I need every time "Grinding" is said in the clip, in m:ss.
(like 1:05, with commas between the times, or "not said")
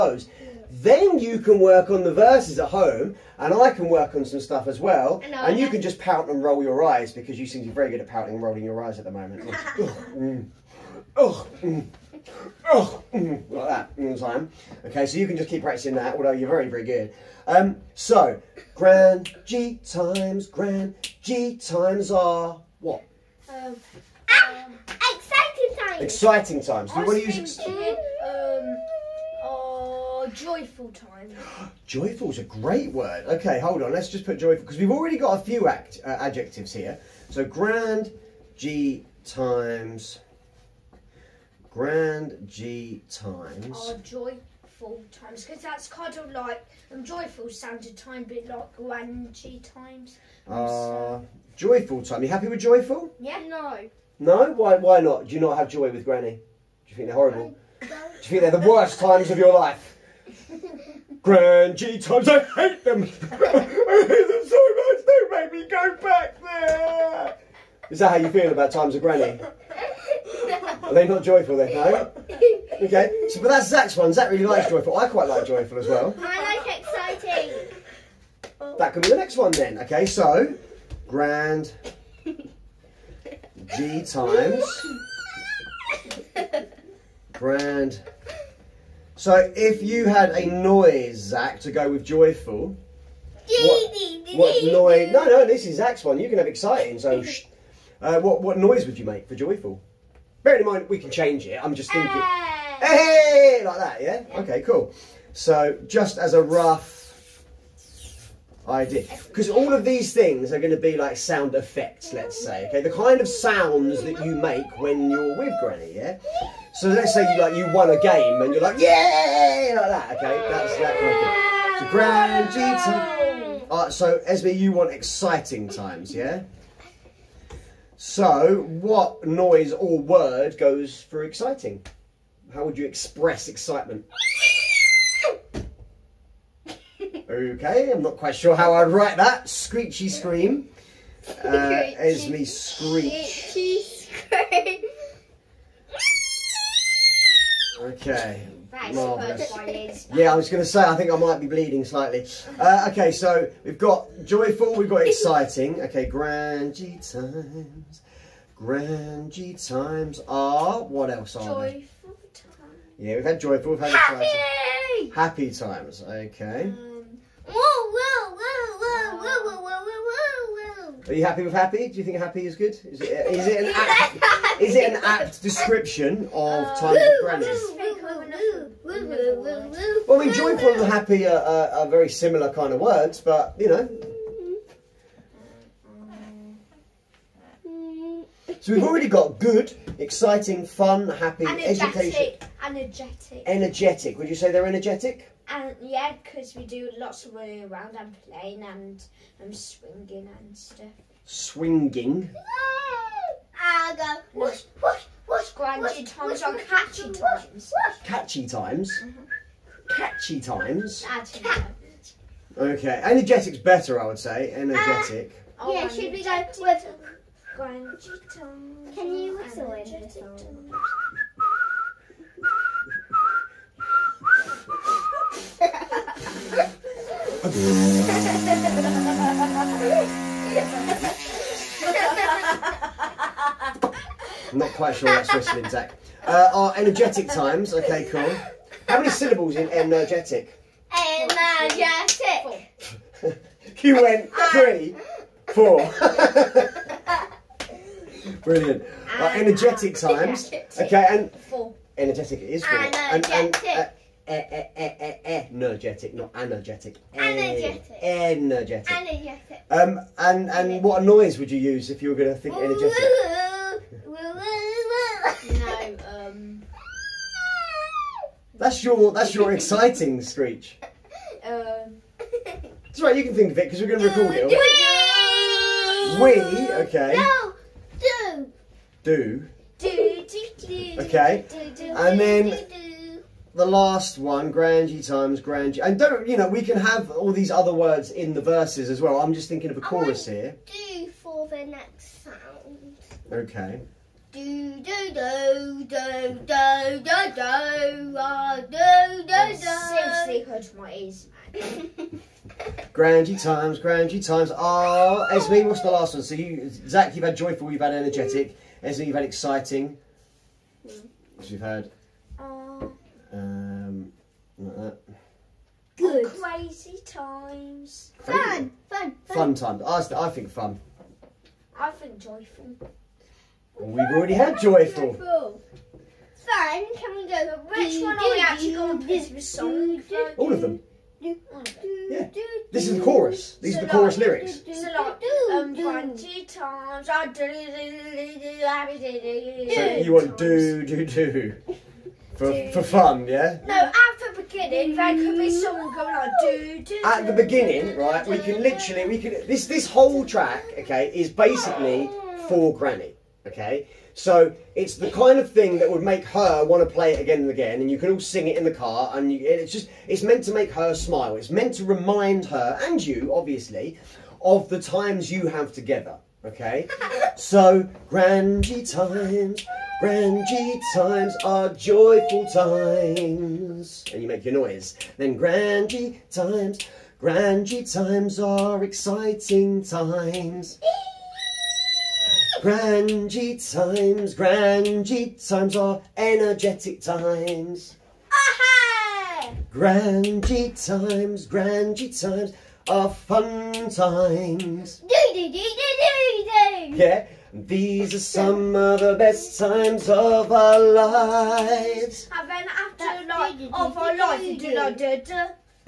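3:25, 3:37.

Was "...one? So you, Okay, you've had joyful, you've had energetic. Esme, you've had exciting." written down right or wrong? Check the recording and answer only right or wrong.
wrong.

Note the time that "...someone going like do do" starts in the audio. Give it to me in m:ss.
5:45.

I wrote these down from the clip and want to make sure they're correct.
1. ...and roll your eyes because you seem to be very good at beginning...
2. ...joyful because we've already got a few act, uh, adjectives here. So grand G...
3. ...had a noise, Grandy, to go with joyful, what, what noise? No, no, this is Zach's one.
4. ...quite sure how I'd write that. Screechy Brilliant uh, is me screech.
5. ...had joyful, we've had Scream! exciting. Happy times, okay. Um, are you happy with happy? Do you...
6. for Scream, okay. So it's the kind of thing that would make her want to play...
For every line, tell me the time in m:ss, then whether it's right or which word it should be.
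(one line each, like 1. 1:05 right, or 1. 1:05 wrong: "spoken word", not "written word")
1. 0:06 wrong: "pouting", not "beginning"
2. 0:34 right
3. 1:30 wrong: "Zach", not "Grandy"
4. 2:18 wrong: "Scream", not "Brilliant"
5. 2:43 wrong: "Happy", not "Scream"
6. 5:52 wrong: "Granny", not "Scream".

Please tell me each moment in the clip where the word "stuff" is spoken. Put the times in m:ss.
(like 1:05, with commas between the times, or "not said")
0:04, 3:20.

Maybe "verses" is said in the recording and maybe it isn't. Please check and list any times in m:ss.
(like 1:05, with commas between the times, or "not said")
0:02, 4:48.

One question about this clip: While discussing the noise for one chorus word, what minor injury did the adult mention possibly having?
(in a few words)
Bleeding.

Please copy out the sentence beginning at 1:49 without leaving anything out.
Because all of these things are going to be like sound effects, let's say.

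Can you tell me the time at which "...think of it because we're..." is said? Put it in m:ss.
4:33.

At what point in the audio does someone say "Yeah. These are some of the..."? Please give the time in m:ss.
6:36.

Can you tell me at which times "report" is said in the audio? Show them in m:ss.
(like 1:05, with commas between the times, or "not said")
not said.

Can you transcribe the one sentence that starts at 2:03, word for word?
Right, uh, so Esme, you want exciting times, yeah?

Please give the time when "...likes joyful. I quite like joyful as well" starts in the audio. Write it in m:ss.
1:14.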